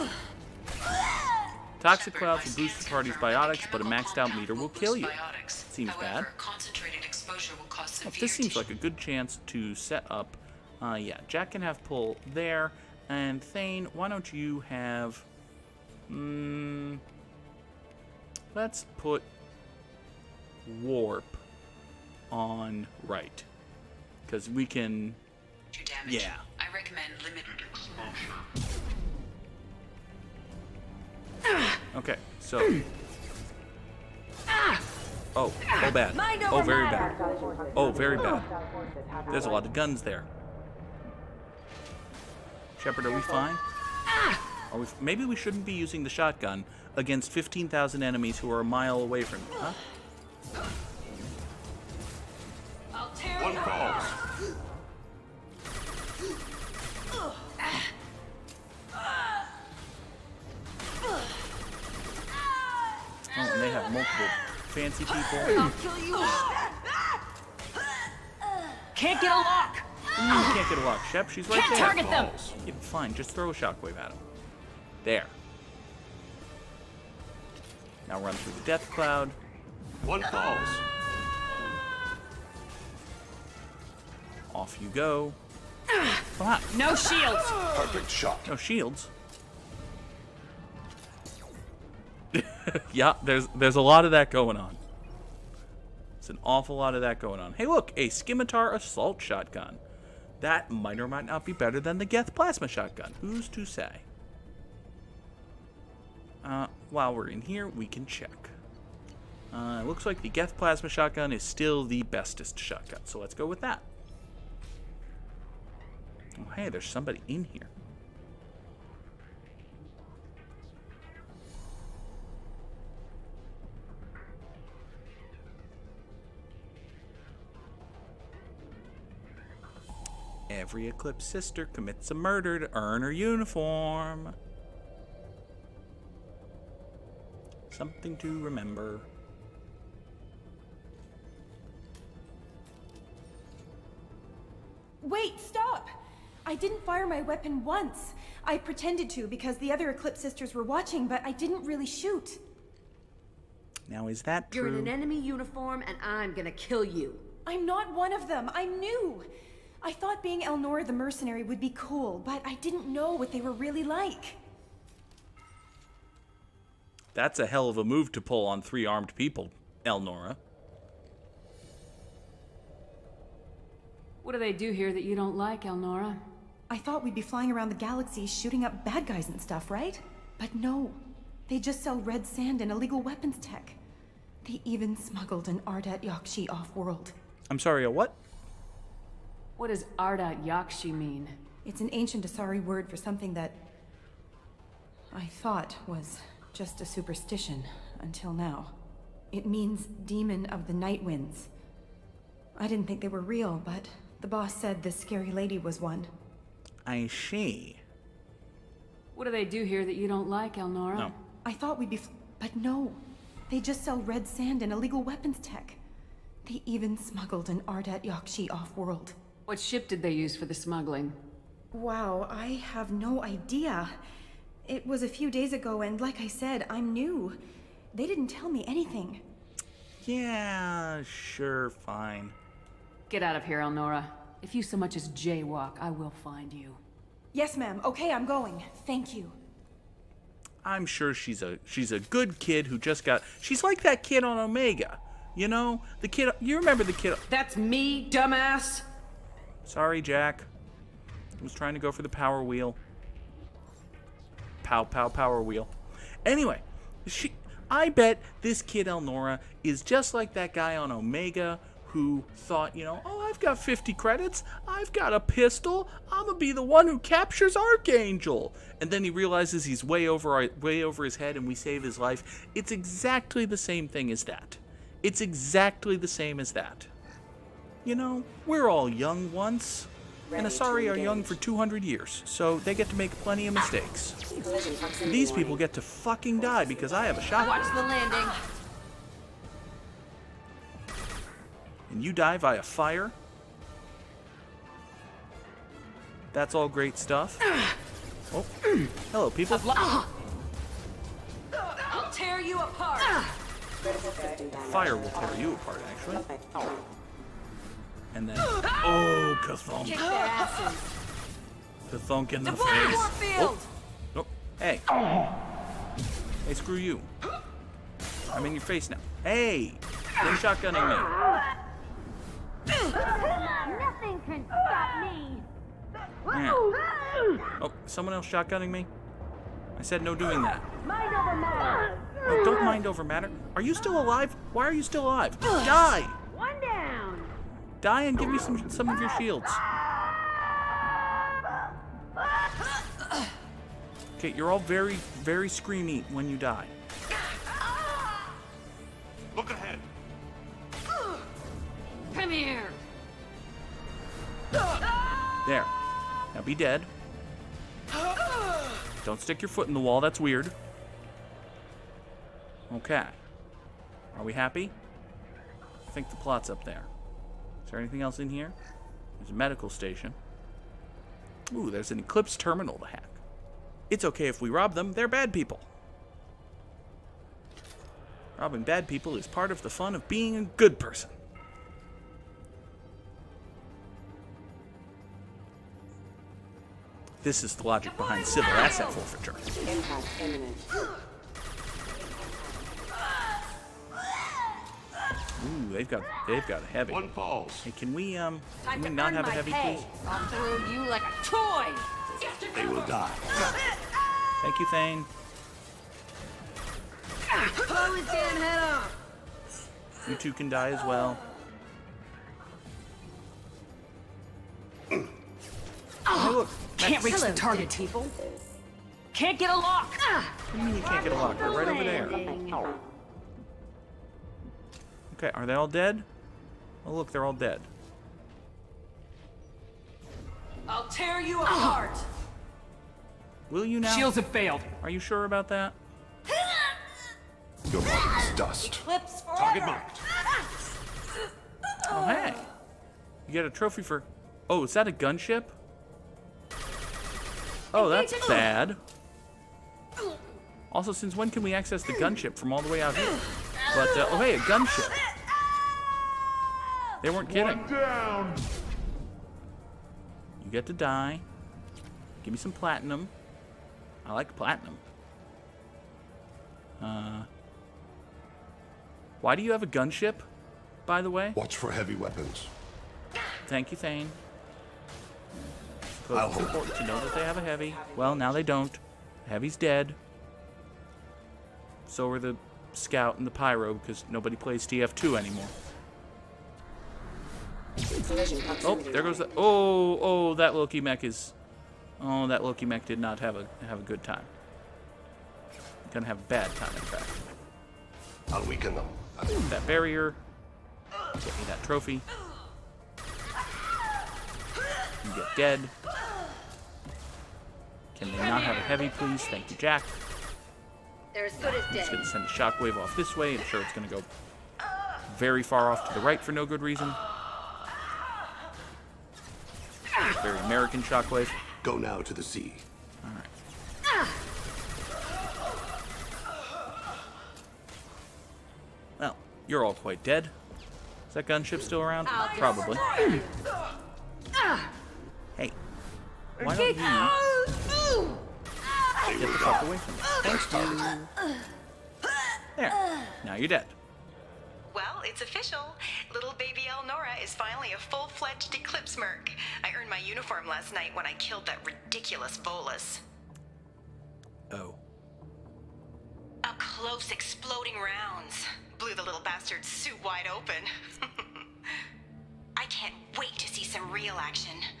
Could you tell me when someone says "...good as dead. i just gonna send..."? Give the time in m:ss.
8:31.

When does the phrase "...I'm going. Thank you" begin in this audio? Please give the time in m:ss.
3:58.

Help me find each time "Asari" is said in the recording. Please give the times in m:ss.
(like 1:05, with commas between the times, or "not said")
3:12, 4:40.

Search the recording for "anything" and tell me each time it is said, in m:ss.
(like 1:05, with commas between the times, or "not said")
3:48, 6:07.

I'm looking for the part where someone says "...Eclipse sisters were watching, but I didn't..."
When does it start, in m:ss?
2:29.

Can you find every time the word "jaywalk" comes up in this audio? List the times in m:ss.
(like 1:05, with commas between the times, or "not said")
3:55.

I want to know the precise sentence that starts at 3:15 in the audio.
I thought was just a superstition, until now.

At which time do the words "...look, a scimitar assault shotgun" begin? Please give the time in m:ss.
1:37.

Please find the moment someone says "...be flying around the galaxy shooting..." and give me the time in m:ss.
2:57.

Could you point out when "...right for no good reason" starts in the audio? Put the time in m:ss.
8:36.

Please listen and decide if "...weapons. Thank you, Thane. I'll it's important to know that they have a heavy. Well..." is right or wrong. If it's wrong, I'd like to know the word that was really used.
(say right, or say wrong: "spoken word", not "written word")
right.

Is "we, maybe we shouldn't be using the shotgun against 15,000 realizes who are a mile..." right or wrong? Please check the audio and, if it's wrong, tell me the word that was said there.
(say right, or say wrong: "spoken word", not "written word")
wrong: "enemies", not "realizes".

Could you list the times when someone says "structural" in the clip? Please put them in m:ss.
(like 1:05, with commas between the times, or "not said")
not said.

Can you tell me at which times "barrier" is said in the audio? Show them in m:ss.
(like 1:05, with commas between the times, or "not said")
8:19.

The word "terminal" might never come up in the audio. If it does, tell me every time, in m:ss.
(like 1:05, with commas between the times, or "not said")
6:12.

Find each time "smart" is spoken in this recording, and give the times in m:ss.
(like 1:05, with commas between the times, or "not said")
not said.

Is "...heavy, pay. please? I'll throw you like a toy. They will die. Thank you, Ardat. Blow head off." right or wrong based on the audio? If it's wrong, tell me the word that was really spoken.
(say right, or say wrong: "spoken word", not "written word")
wrong: "Thane", not "Ardat".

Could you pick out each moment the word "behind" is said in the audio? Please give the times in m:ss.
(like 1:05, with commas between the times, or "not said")
6:27.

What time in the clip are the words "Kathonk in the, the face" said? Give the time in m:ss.
5:11.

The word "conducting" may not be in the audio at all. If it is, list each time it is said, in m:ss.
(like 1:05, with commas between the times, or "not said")
not said.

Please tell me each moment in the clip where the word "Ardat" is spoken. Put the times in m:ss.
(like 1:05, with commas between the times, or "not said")
3:05, 3:09, 3:37.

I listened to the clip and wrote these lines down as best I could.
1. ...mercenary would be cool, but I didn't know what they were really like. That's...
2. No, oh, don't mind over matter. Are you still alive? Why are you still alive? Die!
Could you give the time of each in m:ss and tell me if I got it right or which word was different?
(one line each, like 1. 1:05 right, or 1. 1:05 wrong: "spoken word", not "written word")
1. 2:40 right
2. 5:32 right.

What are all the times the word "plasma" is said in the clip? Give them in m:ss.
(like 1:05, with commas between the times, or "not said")
1:42, 1:50.